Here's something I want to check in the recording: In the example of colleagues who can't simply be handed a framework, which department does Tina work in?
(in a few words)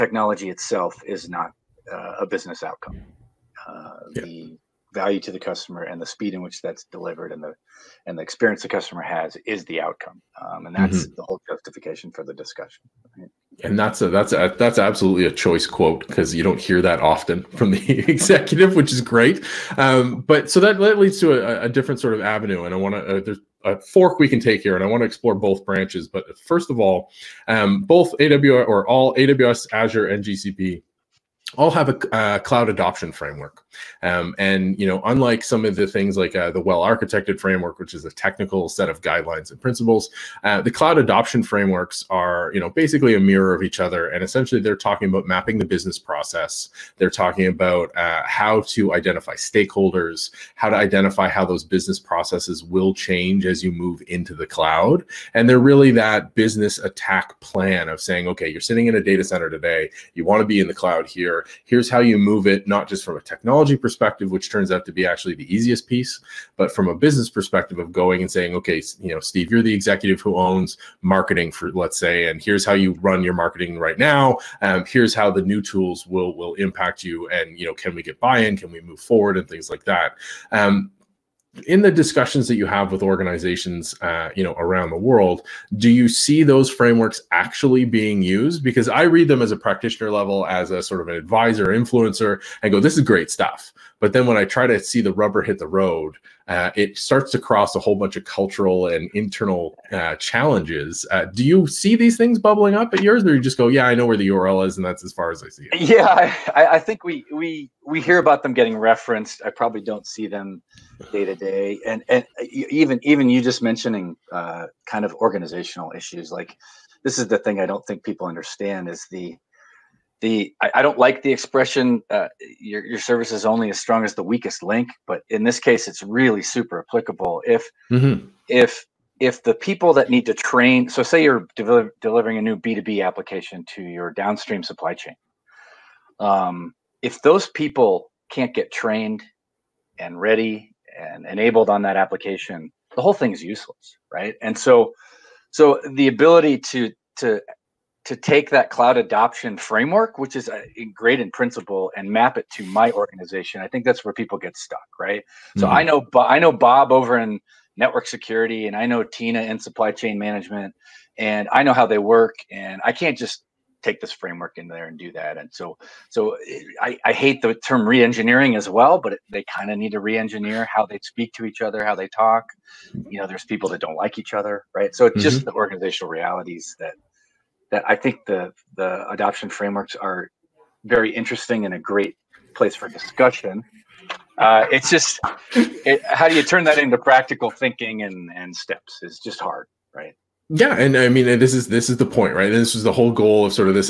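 Supply chain management.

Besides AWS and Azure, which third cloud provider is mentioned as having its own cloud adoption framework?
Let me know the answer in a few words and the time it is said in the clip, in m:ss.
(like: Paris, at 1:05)
GCP, at 0:30.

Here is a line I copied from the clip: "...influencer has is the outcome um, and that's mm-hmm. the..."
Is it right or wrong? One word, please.
wrong.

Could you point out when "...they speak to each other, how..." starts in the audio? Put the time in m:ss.
2:50.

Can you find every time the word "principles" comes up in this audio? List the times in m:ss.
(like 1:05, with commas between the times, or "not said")
0:39, 2:31.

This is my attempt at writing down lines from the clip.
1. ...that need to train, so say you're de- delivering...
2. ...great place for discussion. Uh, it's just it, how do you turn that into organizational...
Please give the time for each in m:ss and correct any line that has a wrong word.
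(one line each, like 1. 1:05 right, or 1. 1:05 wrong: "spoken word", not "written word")
1. 2:09 right
2. 3:01 wrong: "practical", not "organizational".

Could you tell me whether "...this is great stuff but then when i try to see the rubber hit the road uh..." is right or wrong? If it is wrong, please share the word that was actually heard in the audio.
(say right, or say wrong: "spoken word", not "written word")
right.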